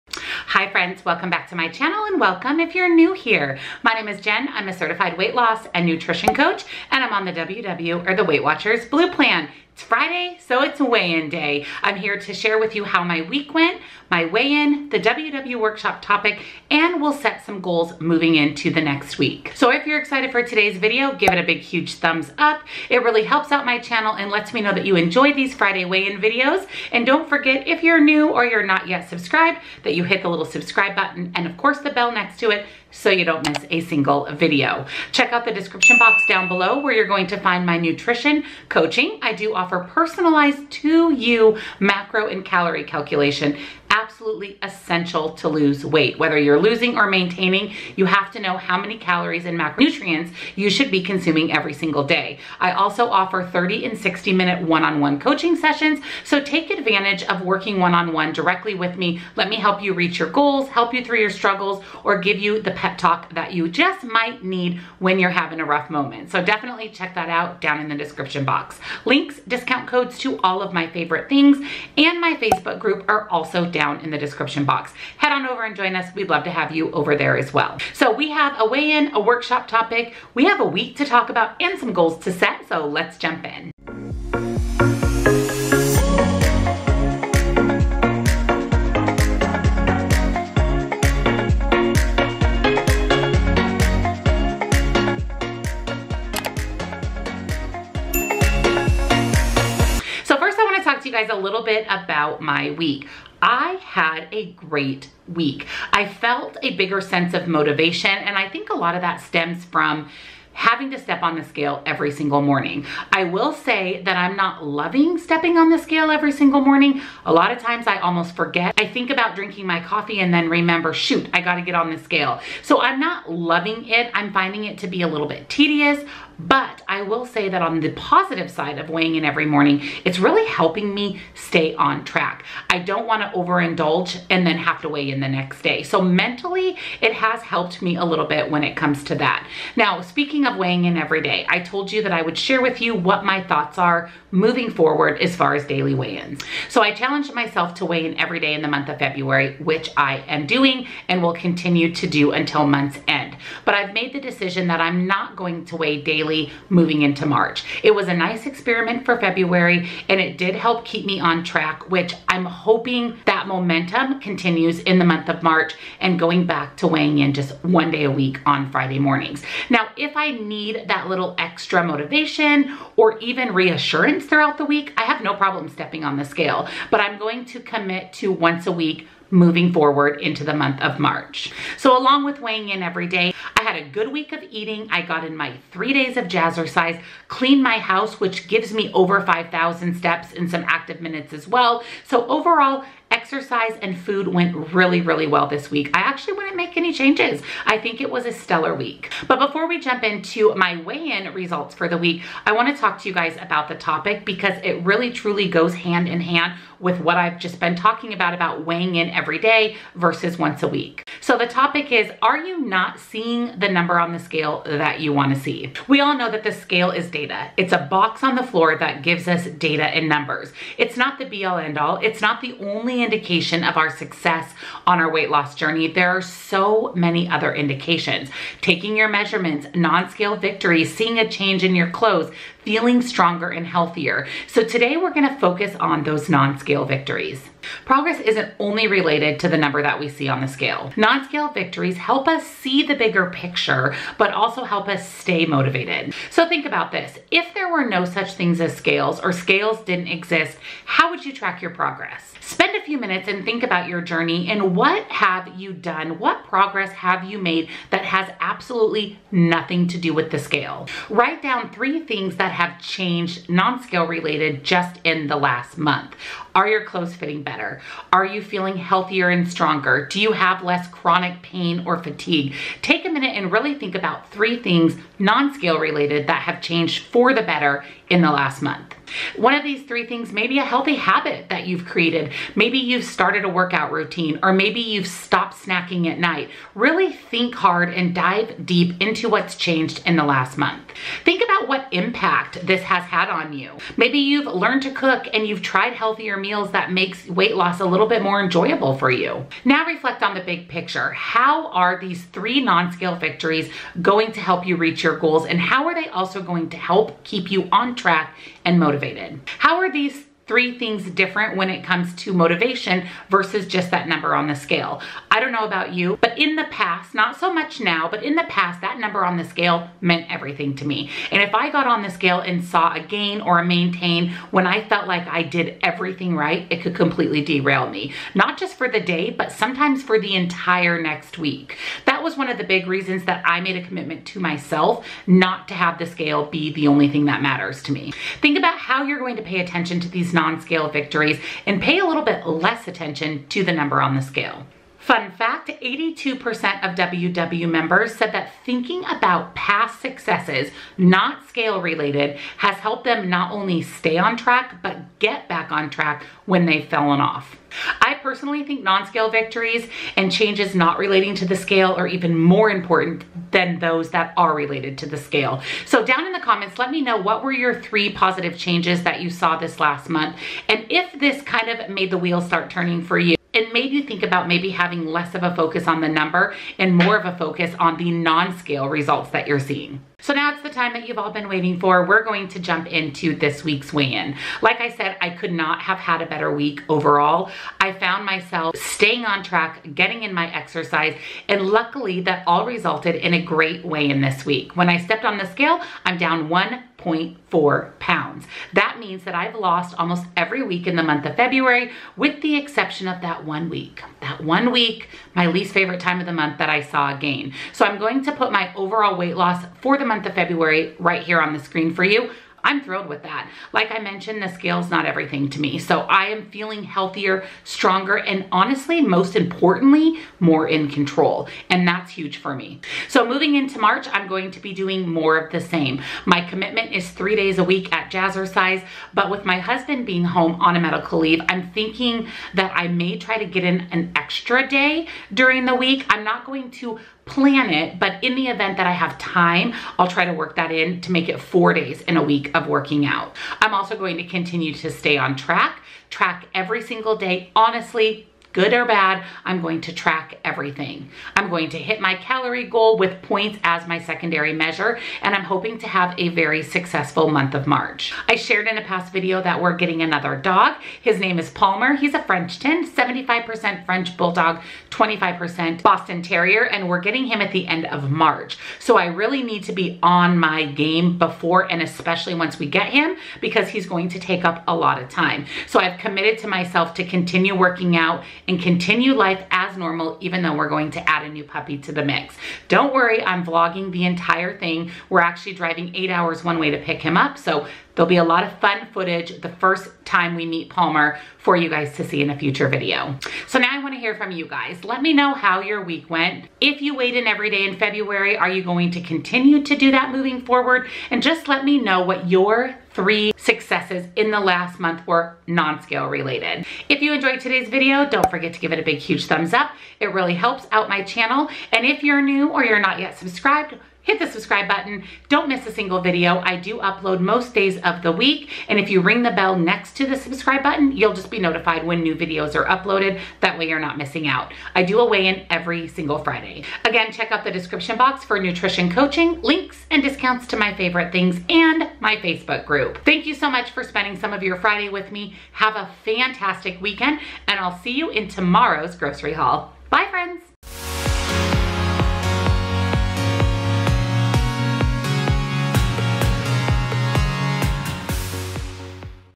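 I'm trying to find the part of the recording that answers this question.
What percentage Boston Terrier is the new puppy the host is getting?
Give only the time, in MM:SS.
07:44.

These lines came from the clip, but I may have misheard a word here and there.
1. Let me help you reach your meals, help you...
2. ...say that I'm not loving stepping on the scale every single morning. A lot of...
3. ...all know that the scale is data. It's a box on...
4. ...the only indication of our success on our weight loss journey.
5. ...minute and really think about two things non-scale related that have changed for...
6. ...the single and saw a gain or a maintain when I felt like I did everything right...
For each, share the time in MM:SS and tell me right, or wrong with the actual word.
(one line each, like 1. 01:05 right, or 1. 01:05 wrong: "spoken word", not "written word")
1. 00:59 wrong: "goals", not "meals"
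2. 01:53 right
3. 03:36 right
4. 03:42 right
5. 04:33 wrong: "three", not "two"
6. 05:22 wrong: "scale", not "single".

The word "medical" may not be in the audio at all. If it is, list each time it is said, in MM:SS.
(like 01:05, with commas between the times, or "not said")
07:10.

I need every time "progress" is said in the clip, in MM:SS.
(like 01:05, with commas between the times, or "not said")
03:57, 04:11, 04:16.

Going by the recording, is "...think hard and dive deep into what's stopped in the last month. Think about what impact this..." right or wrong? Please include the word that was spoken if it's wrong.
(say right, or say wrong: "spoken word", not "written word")
wrong: "changed", not "stopped".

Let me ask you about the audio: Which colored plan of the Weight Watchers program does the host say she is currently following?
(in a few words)
Blue Plan.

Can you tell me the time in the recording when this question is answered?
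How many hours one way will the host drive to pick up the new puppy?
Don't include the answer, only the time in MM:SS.
08:05.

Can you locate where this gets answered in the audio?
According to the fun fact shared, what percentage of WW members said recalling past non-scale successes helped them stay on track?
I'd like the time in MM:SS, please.
05:45.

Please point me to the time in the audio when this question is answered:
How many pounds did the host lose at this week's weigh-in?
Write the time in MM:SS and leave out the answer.
06:36.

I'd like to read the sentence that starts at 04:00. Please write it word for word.
Non-scale victories help us see the bigger picture, but also help us stay motivated.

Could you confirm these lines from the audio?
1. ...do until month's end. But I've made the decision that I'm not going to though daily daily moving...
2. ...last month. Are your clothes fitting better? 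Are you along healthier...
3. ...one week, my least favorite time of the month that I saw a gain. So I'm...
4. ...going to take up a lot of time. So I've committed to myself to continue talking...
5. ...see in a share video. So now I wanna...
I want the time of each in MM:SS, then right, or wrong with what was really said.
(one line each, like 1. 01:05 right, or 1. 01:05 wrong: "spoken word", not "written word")
1. 02:32 wrong: "weigh", not "though"
2. 04:25 wrong: "feeling", not "along"
3. 06:44 right
4. 07:53 wrong: "working", not "talking"
5. 08:12 wrong: "future", not "share".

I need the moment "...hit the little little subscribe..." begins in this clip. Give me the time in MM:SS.
00:30.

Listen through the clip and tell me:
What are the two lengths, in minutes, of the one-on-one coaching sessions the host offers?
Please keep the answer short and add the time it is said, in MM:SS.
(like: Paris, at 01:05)
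30 and 60, at 00:53.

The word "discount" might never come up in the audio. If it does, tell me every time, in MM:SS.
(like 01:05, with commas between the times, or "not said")
01:09, 08:50.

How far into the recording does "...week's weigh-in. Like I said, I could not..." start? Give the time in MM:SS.
06:23.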